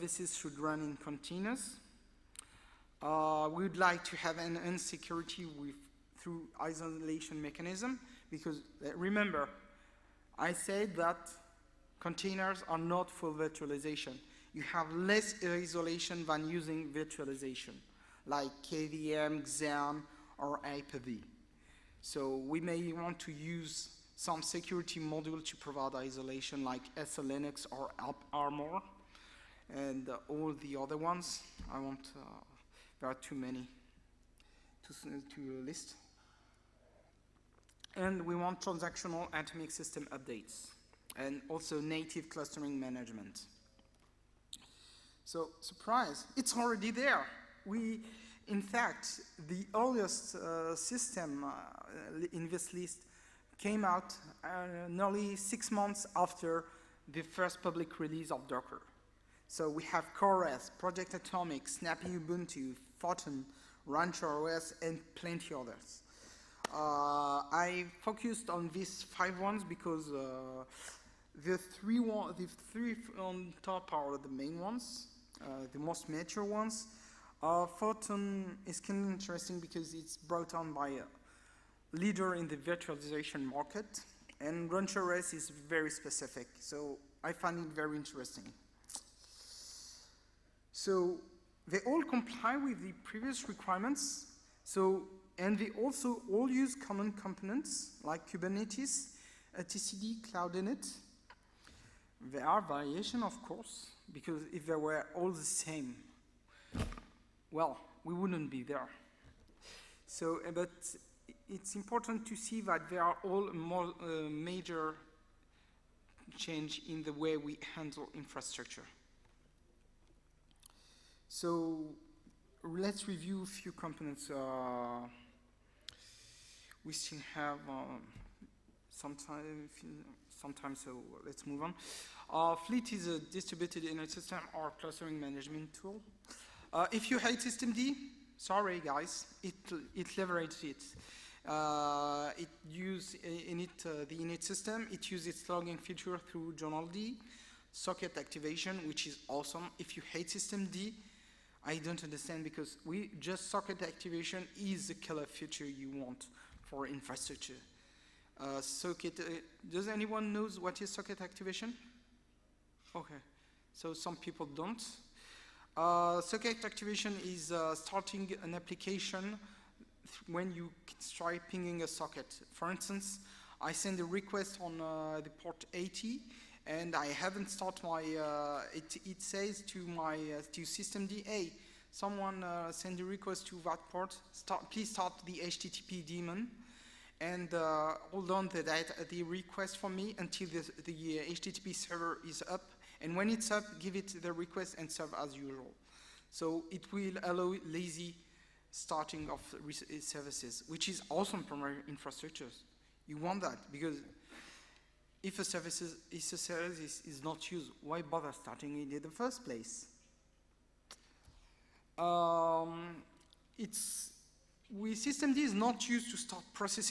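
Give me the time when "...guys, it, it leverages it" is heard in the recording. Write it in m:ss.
2:18.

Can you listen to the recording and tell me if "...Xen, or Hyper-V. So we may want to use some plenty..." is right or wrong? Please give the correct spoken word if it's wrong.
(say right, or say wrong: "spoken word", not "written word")
wrong: "security", not "plenty".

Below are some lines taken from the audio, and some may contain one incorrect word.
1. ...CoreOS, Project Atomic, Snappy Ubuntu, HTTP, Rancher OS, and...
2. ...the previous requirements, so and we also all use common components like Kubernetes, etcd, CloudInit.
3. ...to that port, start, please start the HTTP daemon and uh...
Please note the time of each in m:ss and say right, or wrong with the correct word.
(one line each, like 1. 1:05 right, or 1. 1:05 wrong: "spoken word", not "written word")
1. 1:00 wrong: "Photon", not "HTTP"
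2. 1:32 right
3. 3:03 right.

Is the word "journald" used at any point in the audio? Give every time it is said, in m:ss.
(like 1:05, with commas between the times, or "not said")
2:26.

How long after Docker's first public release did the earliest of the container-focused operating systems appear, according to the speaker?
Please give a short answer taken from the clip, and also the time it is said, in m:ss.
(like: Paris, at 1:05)
nearly 6 months, at 0:54.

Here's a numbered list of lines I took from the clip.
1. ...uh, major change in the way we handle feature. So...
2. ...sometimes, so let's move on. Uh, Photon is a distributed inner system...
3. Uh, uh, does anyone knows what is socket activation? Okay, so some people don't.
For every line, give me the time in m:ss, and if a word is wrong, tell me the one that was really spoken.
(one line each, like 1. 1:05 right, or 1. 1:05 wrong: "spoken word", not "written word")
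1. 1:53 wrong: "infrastructure", not "feature"
2. 2:10 wrong: "Fleet", not "Photon"
3. 2:38 right.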